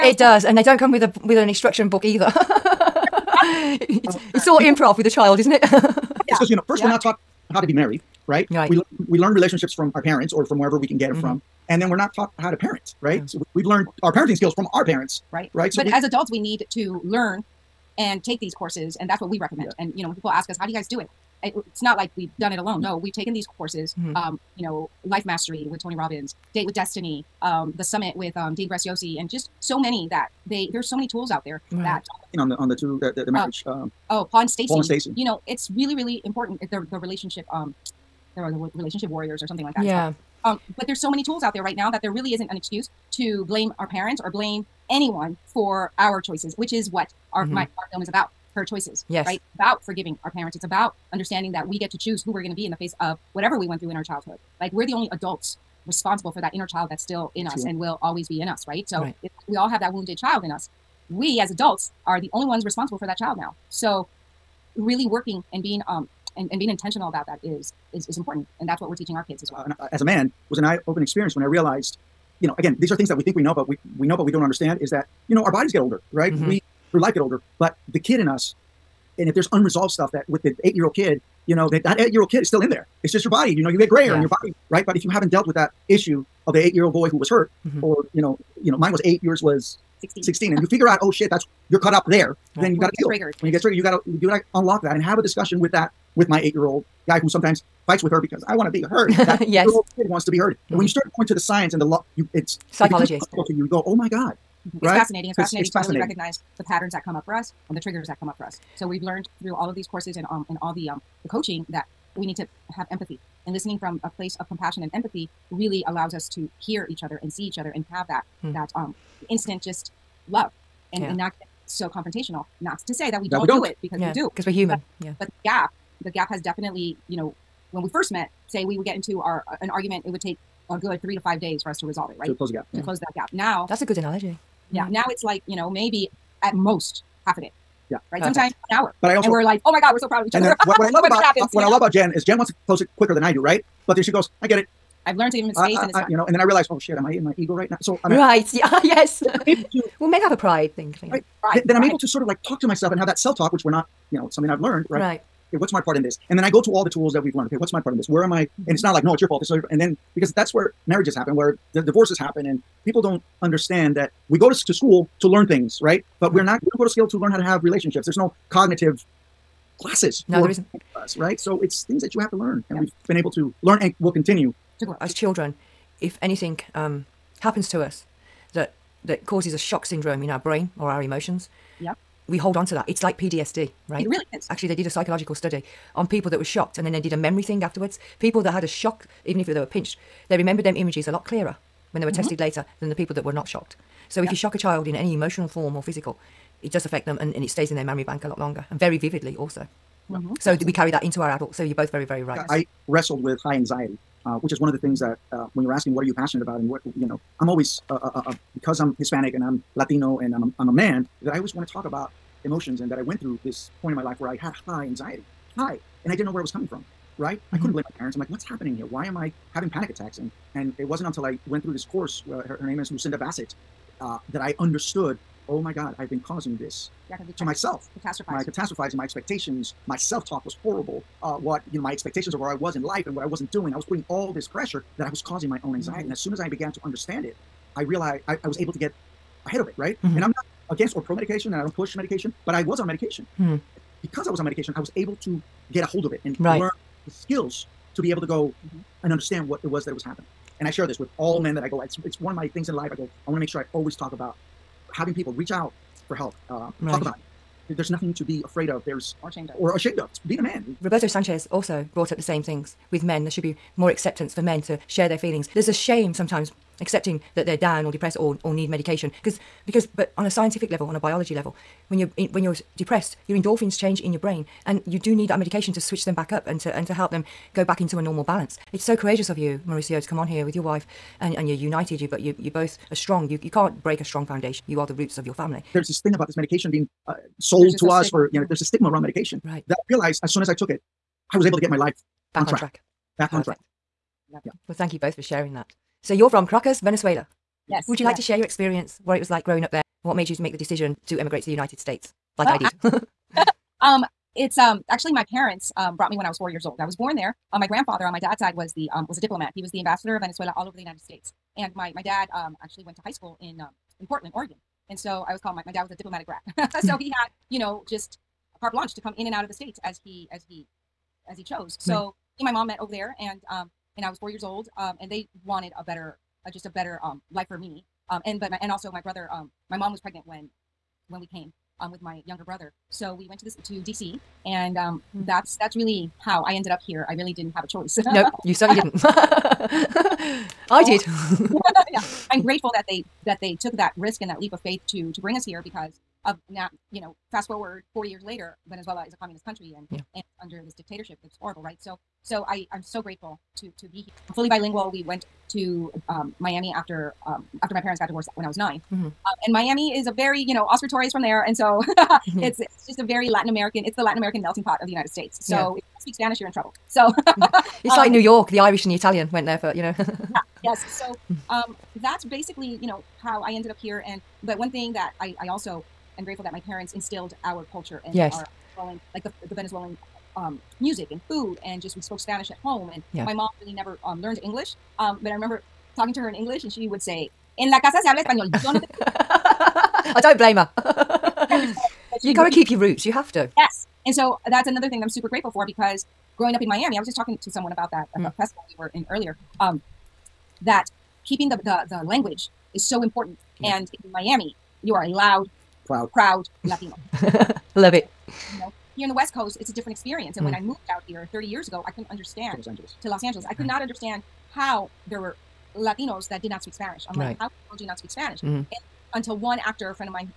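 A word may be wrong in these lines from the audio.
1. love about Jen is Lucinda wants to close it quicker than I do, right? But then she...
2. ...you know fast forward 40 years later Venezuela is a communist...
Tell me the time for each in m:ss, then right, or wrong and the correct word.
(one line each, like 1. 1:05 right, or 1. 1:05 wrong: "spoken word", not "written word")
1. 2:21 wrong: "Jen", not "Lucinda"
2. 5:46 right.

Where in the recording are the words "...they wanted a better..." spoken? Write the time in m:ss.
5:25.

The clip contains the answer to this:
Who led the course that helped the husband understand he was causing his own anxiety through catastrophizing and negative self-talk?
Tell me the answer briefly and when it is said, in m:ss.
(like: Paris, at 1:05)
Lucinda Bassett, at 3:42.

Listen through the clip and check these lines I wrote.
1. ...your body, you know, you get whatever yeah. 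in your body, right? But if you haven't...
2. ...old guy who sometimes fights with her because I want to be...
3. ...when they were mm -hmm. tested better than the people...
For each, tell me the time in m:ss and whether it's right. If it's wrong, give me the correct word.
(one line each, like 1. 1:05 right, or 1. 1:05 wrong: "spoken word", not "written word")
1. 1:23 wrong: "grayer", not "whatever"
2. 1:36 right
3. 3:11 wrong: "later", not "better".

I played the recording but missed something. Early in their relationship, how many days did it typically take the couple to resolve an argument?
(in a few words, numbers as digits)
3 to 5 days.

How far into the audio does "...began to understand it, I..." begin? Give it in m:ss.
3:56.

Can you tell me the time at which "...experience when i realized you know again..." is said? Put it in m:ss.
1:11.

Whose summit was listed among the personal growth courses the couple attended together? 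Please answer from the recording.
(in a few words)
Dean Graziosi.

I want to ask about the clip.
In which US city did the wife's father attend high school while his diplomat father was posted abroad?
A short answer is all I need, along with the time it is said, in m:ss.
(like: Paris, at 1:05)
Portland, Oregon, at 5:14.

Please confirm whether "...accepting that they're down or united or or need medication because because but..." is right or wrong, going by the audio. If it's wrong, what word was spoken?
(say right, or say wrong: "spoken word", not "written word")
wrong: "depressed", not "united".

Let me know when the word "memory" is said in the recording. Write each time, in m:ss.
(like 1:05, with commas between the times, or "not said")
3:07, 3:17.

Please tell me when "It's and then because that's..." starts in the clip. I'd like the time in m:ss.
2:39.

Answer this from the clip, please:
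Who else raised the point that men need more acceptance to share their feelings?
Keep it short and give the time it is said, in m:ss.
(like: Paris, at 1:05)
Roberto Sanchez, at 4:20.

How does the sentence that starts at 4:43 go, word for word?
You you can't break a strong foundation.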